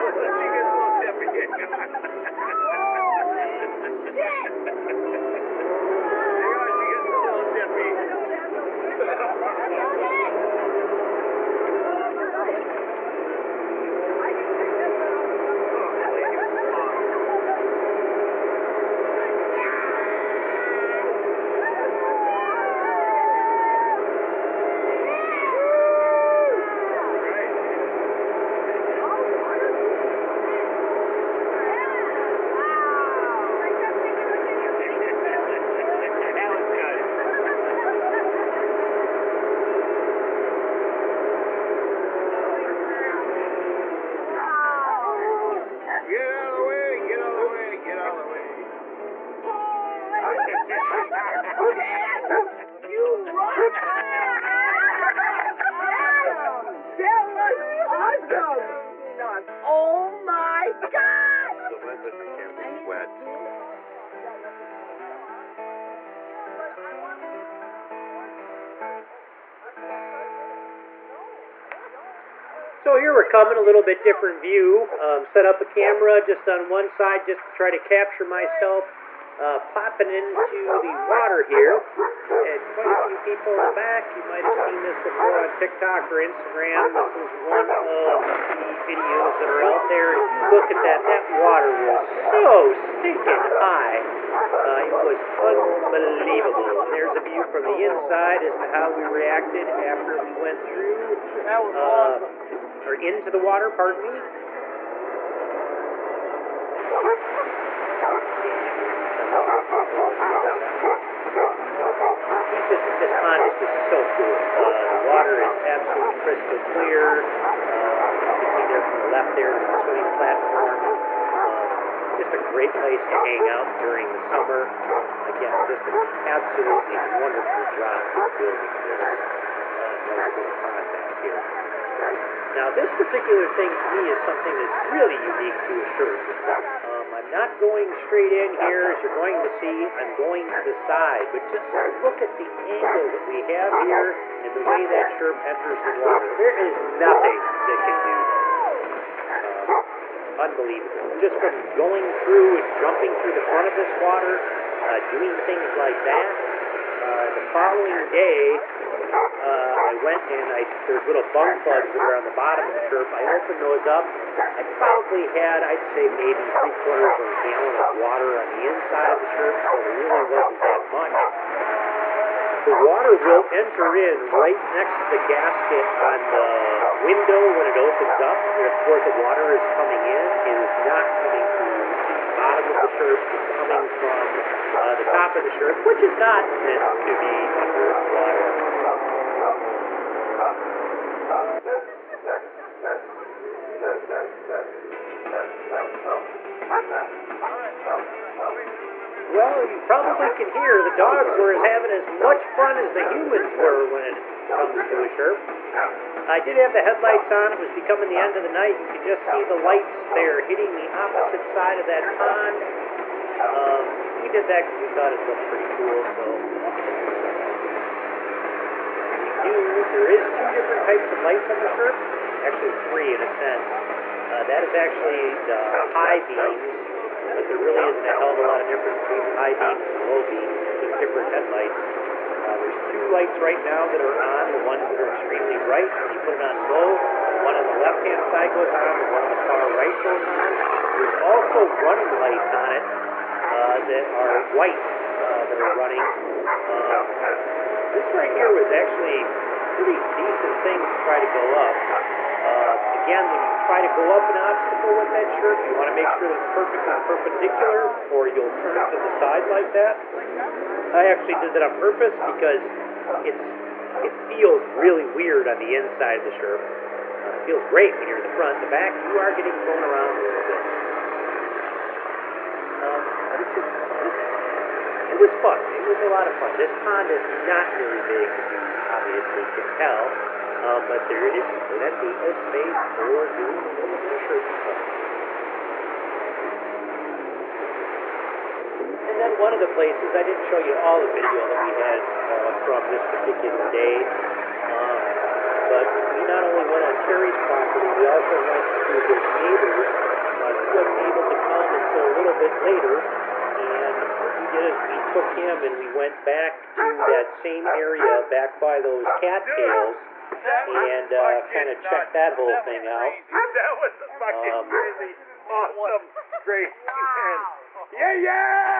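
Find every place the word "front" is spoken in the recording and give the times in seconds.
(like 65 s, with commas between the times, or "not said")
153 s, 268 s.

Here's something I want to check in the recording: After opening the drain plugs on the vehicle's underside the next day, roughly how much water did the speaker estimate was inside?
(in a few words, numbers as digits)
3/4 of a gallon.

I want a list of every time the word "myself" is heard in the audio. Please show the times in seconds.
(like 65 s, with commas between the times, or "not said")
78 s.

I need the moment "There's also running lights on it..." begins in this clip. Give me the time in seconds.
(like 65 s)
240 s.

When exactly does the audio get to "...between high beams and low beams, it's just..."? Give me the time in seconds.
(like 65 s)
229 s.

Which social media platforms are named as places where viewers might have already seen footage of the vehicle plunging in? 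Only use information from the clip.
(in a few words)
TikTok or Instagram.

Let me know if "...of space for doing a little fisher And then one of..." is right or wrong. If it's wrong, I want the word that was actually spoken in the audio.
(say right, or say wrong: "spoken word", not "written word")
right.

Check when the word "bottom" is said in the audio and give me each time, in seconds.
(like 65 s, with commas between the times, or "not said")
162 s, 182 s.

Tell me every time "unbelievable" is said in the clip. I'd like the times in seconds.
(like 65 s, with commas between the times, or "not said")
95 s, 150 s.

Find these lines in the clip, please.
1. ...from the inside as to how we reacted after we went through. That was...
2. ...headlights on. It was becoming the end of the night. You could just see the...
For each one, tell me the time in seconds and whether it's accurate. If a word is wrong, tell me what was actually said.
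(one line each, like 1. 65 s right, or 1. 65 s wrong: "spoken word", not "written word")
1. 97 s right
2. 206 s right.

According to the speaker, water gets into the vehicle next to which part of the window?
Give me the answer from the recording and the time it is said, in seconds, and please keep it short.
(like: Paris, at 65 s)
the gasket, at 175 s.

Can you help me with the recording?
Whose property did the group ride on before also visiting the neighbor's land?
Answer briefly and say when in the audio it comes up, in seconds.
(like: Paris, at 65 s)
Terry's, at 297 s.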